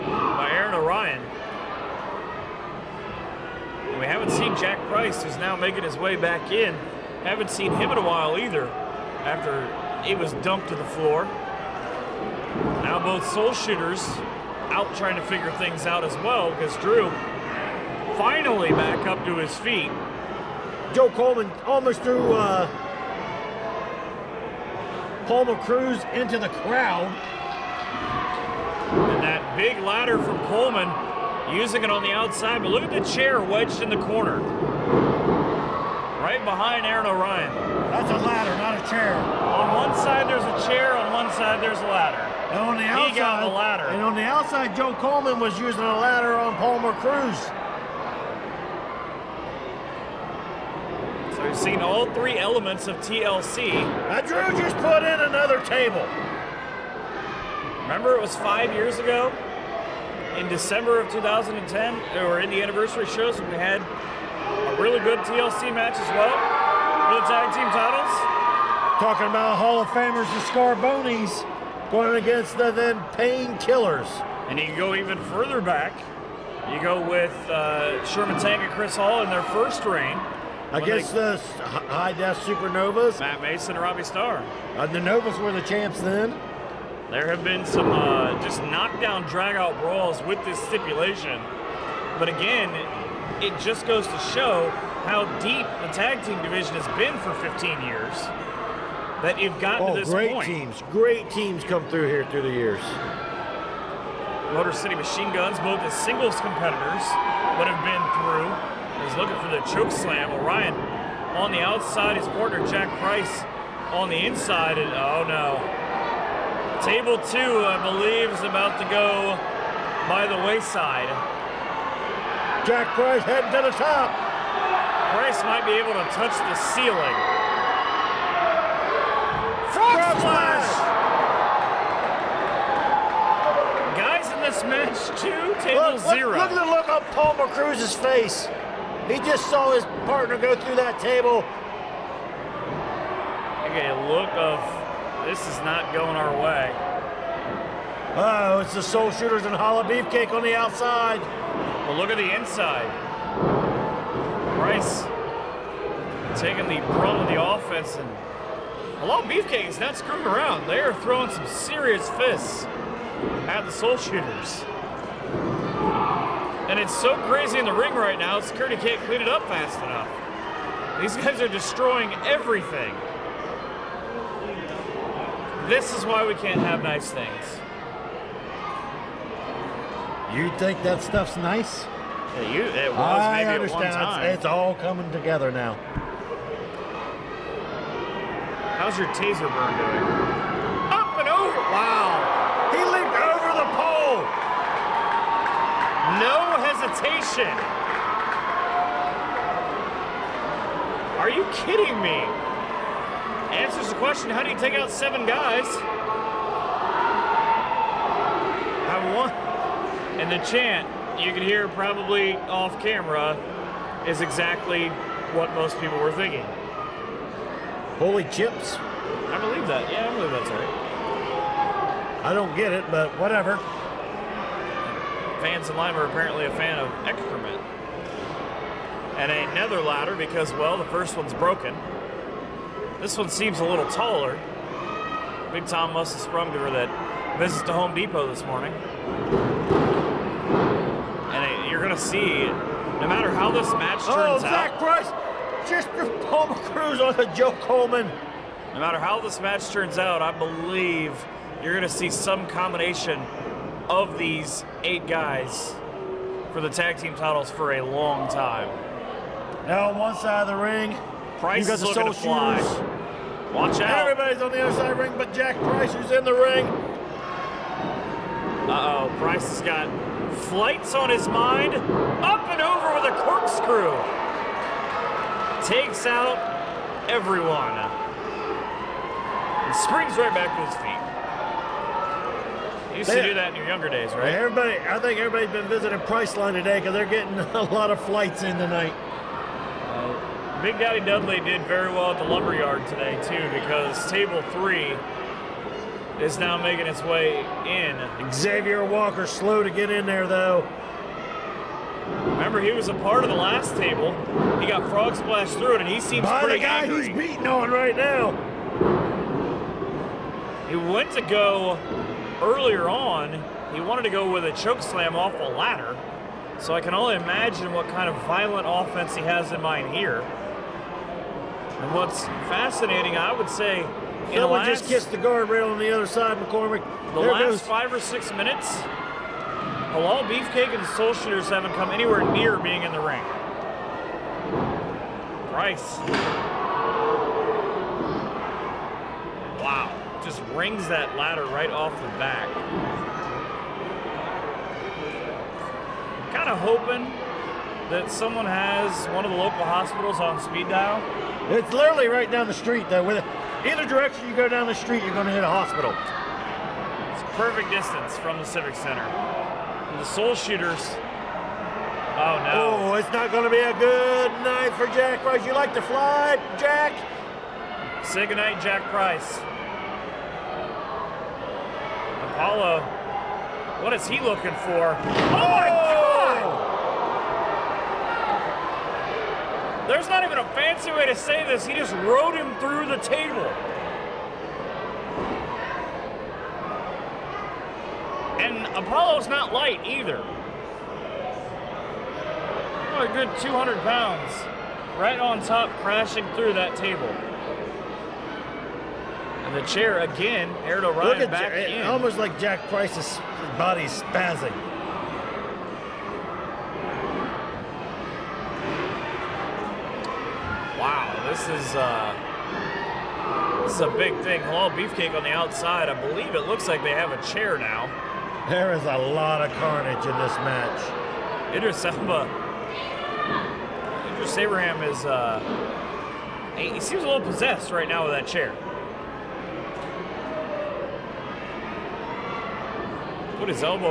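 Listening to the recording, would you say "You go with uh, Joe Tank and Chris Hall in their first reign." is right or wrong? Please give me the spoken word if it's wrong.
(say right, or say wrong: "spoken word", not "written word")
wrong: "Sherman", not "Joe".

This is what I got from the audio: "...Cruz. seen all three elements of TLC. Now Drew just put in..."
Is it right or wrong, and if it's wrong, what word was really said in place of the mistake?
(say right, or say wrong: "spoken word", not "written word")
right.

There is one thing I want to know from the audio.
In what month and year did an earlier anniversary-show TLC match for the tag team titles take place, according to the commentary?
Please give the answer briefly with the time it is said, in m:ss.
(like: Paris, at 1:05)
December 2010, at 1:00.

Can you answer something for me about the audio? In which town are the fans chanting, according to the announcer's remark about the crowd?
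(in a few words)
Lima.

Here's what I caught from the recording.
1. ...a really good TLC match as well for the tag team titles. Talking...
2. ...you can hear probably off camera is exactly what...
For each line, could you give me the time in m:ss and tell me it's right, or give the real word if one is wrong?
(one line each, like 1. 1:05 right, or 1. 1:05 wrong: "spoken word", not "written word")
1. 1:04 right
2. 3:31 right.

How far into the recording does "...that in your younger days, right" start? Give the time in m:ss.
4:43.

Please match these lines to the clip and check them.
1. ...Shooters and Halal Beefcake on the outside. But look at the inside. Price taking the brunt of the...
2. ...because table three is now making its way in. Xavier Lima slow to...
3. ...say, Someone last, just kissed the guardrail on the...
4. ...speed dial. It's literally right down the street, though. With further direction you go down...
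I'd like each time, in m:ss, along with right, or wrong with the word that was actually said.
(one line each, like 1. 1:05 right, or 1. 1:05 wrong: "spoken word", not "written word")
1. 2:29 right
2. 4:53 wrong: "Walker", not "Lima"
3. 5:23 right
4. 5:50 wrong: "either", not "further".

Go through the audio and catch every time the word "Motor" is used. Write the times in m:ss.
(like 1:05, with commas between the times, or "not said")
1:44.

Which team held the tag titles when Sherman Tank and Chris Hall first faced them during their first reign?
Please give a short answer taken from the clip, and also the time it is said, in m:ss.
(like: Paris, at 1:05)
the Novas, at 1:24.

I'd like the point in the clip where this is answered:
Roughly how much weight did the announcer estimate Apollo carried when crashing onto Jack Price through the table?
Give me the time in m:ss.
6:33.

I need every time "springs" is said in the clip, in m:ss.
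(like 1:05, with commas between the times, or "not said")
4:39.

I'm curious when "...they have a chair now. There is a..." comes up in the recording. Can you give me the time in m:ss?
6:56.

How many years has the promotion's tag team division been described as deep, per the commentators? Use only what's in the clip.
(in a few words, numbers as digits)
15.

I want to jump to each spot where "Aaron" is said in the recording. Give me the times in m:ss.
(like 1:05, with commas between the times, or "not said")
0:00, 0:36, 6:40.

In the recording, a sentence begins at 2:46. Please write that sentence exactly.
And it's so crazy in the ring right now, security can't clean it up fast enough.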